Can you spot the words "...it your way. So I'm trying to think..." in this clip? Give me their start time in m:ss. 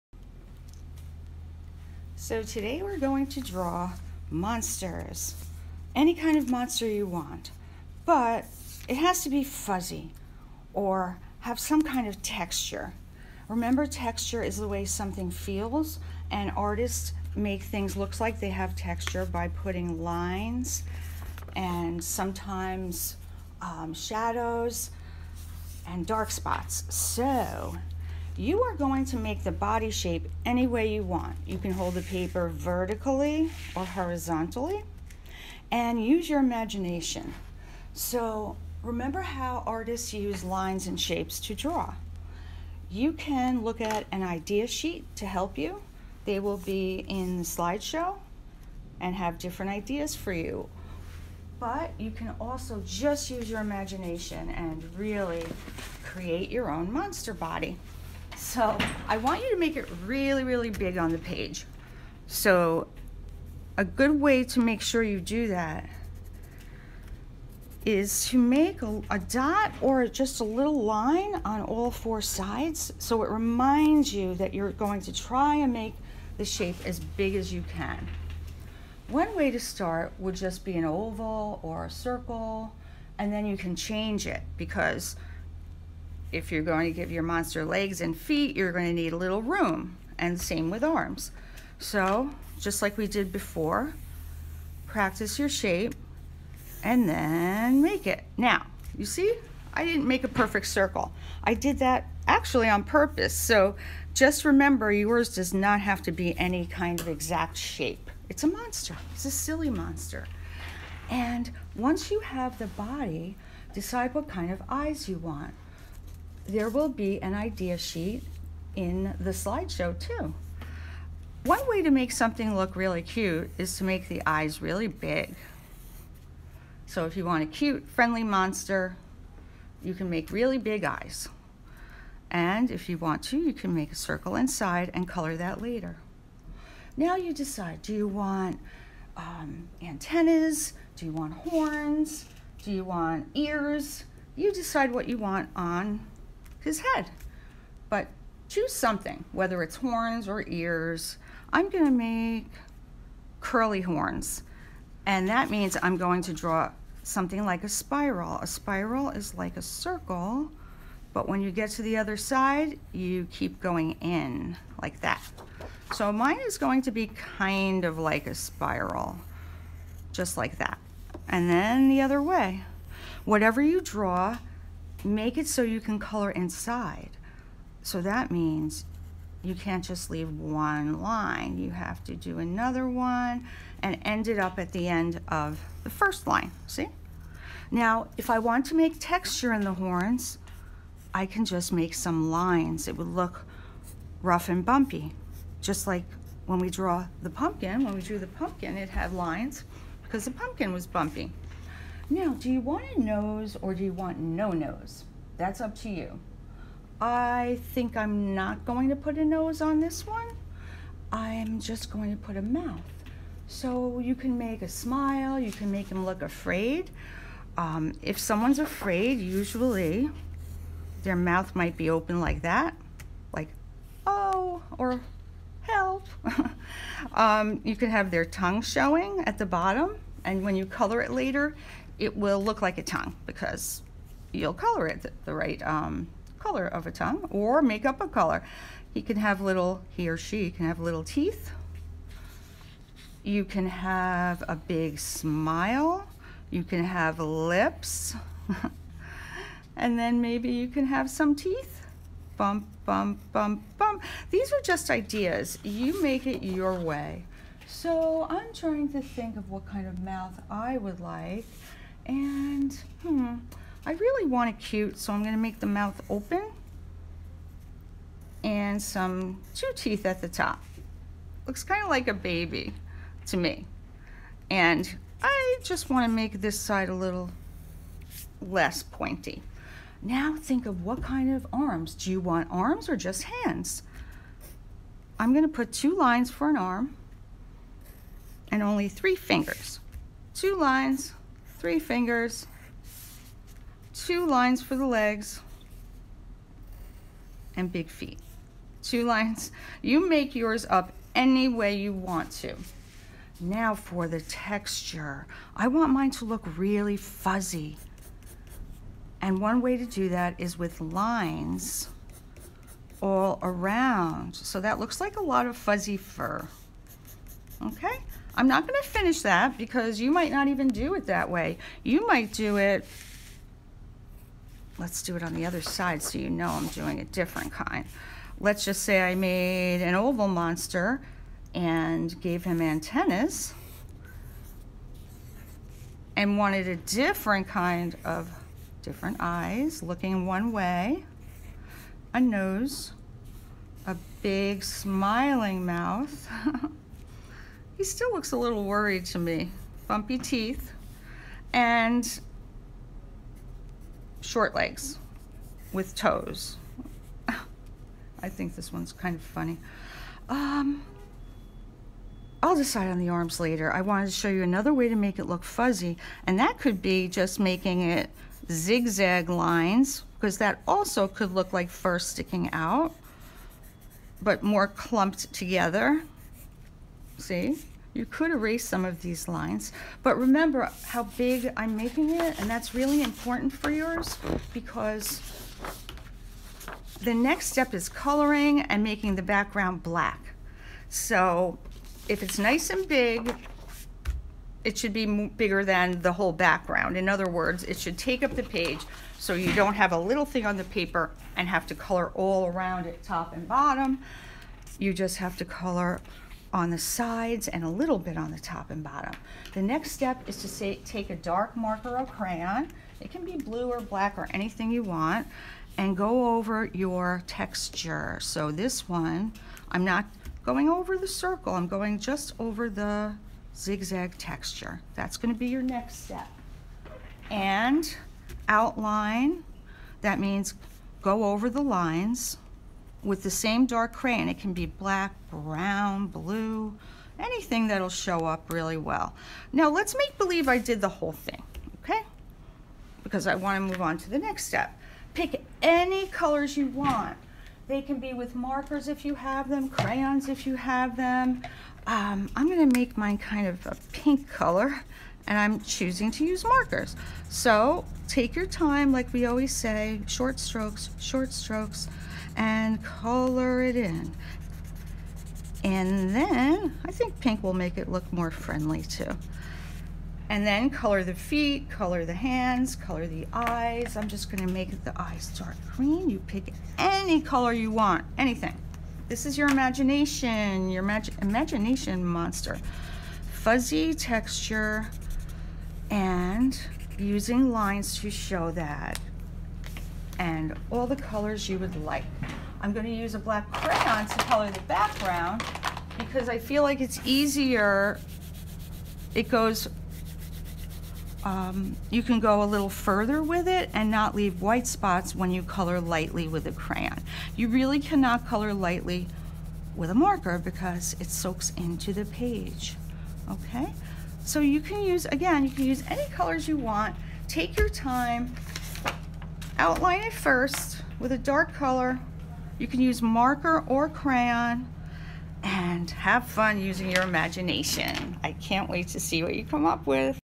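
4:16.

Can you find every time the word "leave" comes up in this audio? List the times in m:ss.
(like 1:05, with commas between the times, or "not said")
3:00, 8:24.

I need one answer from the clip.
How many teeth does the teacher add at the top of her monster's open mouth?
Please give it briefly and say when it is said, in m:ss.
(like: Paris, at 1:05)
2, at 4:29.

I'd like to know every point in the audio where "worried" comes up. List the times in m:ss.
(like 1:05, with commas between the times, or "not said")
5:48.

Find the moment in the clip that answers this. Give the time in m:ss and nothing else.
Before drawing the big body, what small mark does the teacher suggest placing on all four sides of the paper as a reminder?
1:09.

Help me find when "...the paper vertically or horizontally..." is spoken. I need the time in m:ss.
0:31.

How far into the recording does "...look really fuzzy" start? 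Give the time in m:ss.
5:06.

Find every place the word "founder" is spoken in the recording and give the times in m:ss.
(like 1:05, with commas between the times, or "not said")
not said.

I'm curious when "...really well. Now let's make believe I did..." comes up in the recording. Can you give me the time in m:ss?
7:18.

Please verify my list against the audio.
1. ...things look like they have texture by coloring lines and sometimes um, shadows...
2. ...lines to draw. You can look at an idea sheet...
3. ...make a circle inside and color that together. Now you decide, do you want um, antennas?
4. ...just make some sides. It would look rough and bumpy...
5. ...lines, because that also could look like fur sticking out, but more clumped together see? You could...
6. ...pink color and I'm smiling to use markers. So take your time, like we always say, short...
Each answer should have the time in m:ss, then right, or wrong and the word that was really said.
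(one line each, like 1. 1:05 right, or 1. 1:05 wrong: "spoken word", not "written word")
1. 0:17 wrong: "putting", not "coloring"
2. 0:40 wrong: "shapes", not "lines"
3. 2:13 wrong: "later", not "together"
4. 3:11 wrong: "lines", not "sides"
5. 6:09 right
6. 7:33 wrong: "choosing", not "smiling".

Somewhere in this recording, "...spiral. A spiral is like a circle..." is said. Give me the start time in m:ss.
2:37.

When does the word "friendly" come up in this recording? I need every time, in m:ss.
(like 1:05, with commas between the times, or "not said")
2:07, 7:48.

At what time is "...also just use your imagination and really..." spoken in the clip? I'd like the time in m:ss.
0:52.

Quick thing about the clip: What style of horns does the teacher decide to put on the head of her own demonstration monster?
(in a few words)
curly horns.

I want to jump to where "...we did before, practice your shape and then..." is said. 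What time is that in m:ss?
1:32.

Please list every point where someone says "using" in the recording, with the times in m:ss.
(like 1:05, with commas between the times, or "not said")
8:06, 8:46.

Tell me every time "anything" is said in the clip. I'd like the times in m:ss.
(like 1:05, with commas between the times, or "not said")
6:54, 7:17, 7:58.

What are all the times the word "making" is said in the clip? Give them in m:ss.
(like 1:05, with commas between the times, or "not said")
6:07, 6:21, 6:28.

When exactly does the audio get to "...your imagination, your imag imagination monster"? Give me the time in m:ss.
7:59.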